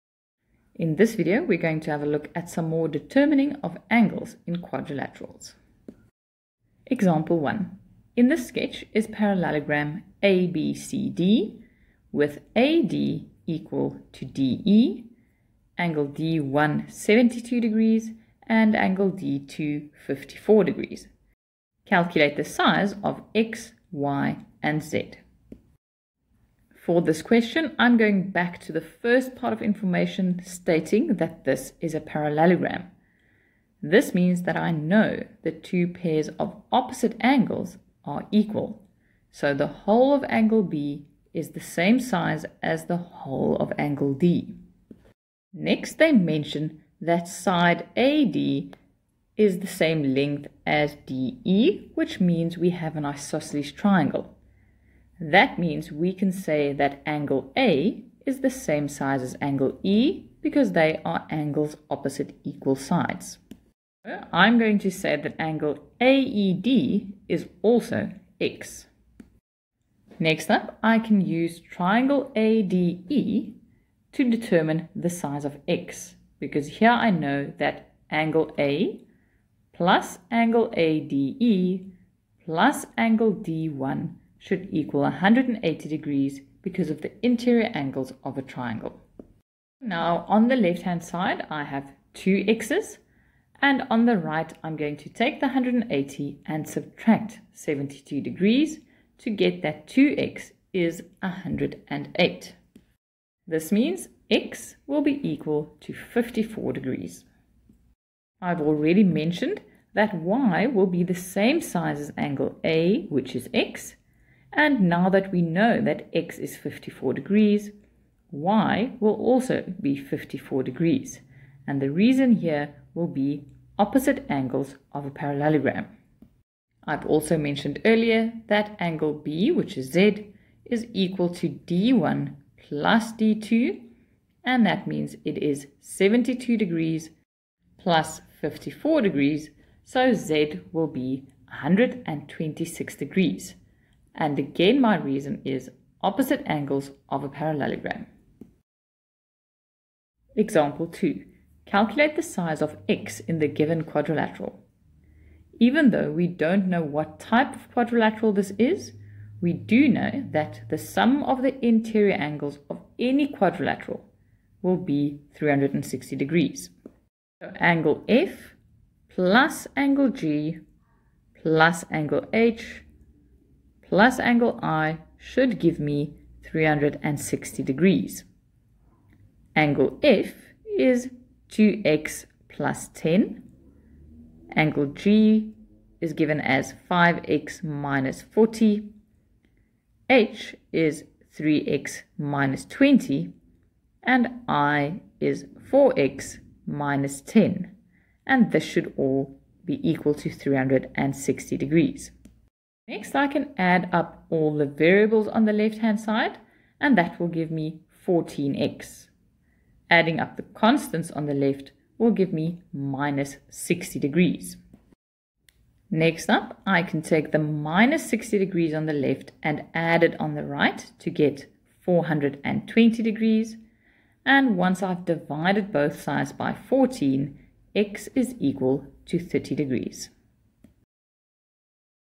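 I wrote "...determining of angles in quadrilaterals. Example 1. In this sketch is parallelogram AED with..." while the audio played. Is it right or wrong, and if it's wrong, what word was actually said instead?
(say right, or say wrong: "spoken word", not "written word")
wrong: "ABCD", not "AED".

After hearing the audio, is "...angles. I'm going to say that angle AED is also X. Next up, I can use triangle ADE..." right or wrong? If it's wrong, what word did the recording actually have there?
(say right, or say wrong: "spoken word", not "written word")
wrong: "sides", not "angles".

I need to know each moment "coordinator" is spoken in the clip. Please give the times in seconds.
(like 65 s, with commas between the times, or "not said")
not said.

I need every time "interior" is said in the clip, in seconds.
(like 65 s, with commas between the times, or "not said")
87 s, 161 s.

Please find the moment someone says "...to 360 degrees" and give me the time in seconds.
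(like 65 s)
200 s.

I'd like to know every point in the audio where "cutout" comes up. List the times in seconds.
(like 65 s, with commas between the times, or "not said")
not said.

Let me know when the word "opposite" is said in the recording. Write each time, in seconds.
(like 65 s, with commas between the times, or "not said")
36 s, 61 s, 123 s, 146 s.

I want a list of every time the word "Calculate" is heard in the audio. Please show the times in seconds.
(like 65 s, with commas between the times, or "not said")
21 s, 151 s.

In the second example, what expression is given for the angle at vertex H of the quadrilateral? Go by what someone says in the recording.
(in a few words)
3x - 20.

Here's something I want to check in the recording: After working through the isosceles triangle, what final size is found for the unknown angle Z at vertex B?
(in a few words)
126 degrees.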